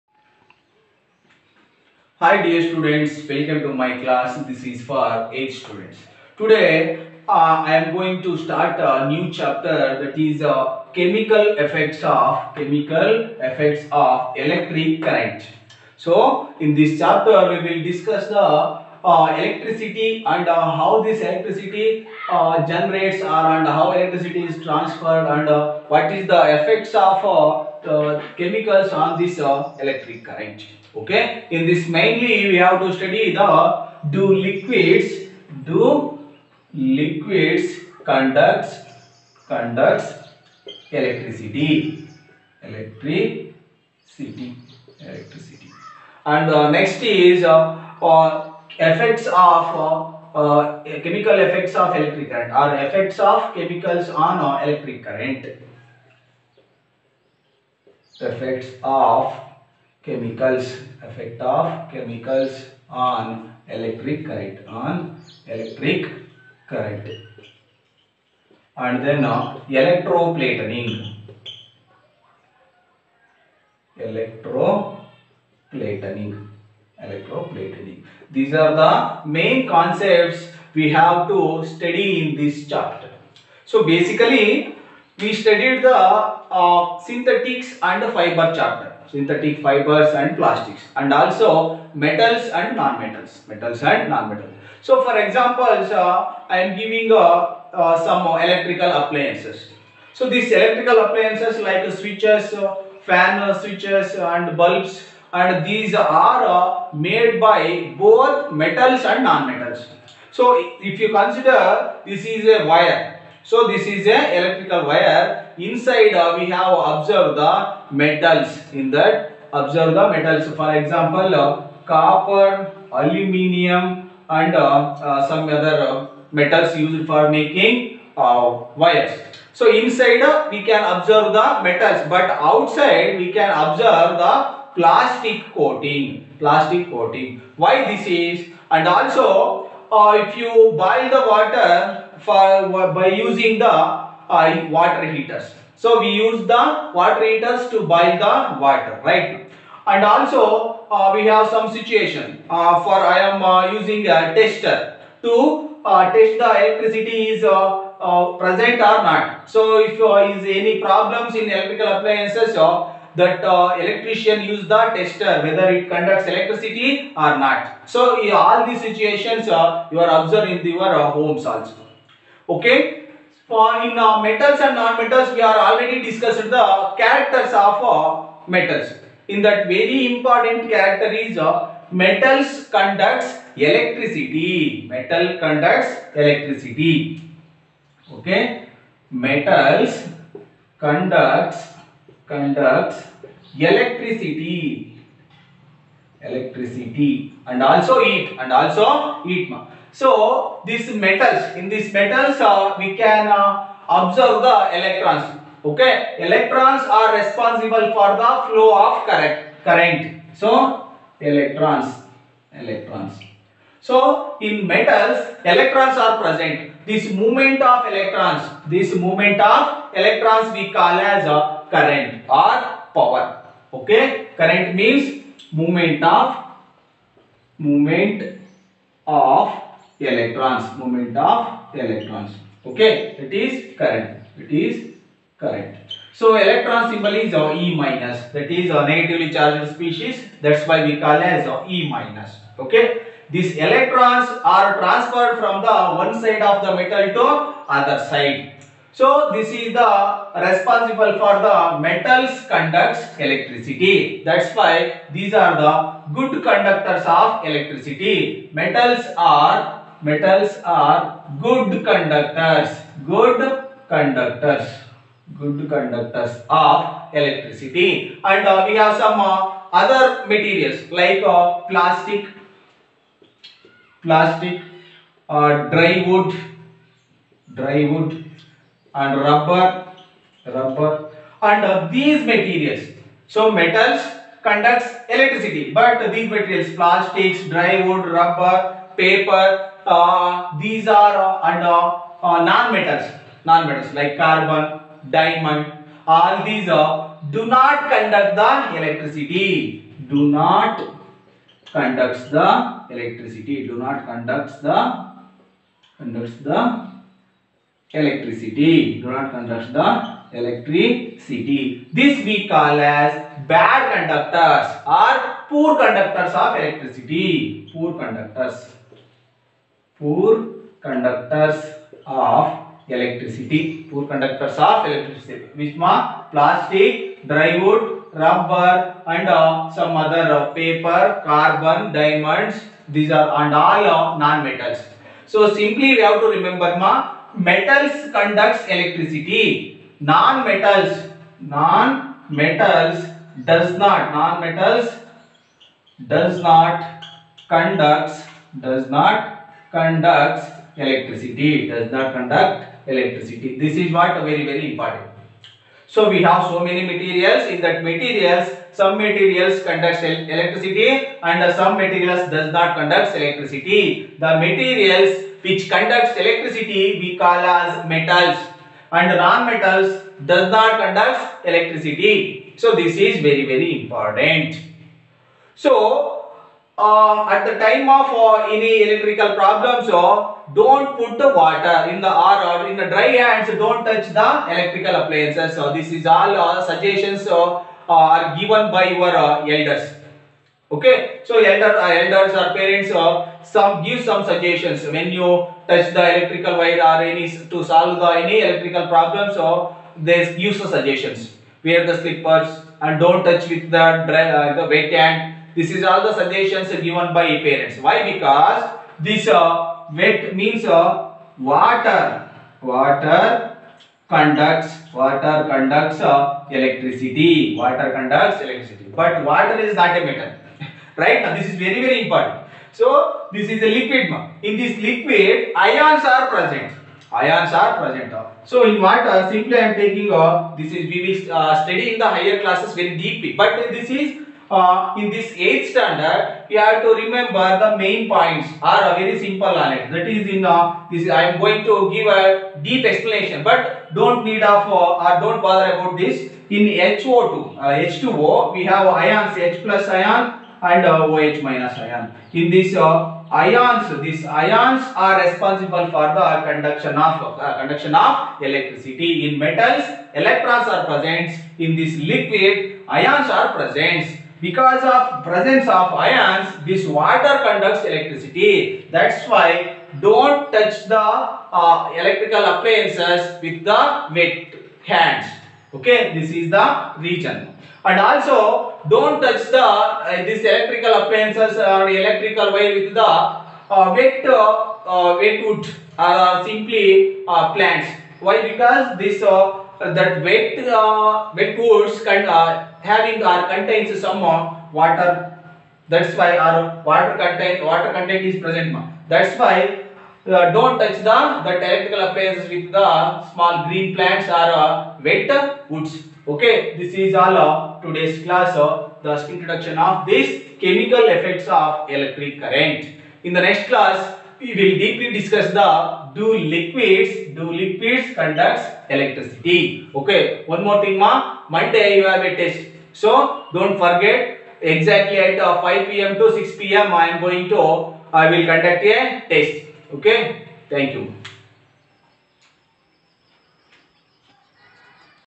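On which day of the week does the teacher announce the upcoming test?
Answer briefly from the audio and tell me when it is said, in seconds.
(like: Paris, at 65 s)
Monday, at 521 s.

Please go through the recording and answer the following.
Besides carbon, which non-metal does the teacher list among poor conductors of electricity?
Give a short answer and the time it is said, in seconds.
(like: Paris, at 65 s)
diamond, at 295 s.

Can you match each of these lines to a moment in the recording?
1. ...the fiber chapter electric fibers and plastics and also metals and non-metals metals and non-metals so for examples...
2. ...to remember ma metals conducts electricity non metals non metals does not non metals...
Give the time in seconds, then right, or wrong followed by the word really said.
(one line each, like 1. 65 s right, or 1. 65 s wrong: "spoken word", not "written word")
1. 88 s wrong: "synthetic", not "electric"
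2. 336 s right.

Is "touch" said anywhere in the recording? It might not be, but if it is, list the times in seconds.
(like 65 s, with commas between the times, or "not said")
383 s, 395 s, 403 s, 470 s, 479 s, 500 s.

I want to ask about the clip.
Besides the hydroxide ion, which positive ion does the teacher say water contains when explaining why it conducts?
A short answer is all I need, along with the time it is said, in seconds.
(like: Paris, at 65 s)
H plus ion, at 449 s.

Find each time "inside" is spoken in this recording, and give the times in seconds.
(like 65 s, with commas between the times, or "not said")
115 s, 129 s.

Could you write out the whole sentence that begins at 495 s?
That's why our water content water content is present.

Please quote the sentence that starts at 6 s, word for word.
Today uh, I am going to start a new chapter that is uh, chemical effects of chemical effects of electric current.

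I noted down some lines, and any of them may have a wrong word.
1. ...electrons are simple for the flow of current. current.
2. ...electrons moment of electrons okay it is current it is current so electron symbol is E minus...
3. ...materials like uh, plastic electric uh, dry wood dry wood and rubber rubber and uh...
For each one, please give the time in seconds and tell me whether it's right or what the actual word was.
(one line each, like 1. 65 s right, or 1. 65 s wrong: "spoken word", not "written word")
1. 206 s wrong: "responsible", not "simple"
2. 230 s right
3. 270 s wrong: "plastic", not "electric".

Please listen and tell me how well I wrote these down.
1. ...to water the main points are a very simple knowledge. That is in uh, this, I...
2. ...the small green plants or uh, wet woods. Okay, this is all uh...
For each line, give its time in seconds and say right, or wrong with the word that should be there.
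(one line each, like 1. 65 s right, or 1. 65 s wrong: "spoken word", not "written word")
1. 436 s wrong: "remember", not "water"
2. 502 s right.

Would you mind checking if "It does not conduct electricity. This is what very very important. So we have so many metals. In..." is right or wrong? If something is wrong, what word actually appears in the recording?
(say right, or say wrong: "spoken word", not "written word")
wrong: "materials", not "metals".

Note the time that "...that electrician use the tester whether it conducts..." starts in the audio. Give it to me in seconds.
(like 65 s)
163 s.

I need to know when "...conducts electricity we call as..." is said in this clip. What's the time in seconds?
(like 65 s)
365 s.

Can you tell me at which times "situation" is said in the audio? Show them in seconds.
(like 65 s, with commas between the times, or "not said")
151 s, 168 s.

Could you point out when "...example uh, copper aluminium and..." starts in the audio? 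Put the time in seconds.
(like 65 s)
120 s.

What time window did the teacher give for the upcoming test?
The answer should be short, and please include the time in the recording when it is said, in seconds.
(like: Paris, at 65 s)
5 pm to 6 pm, at 525 s.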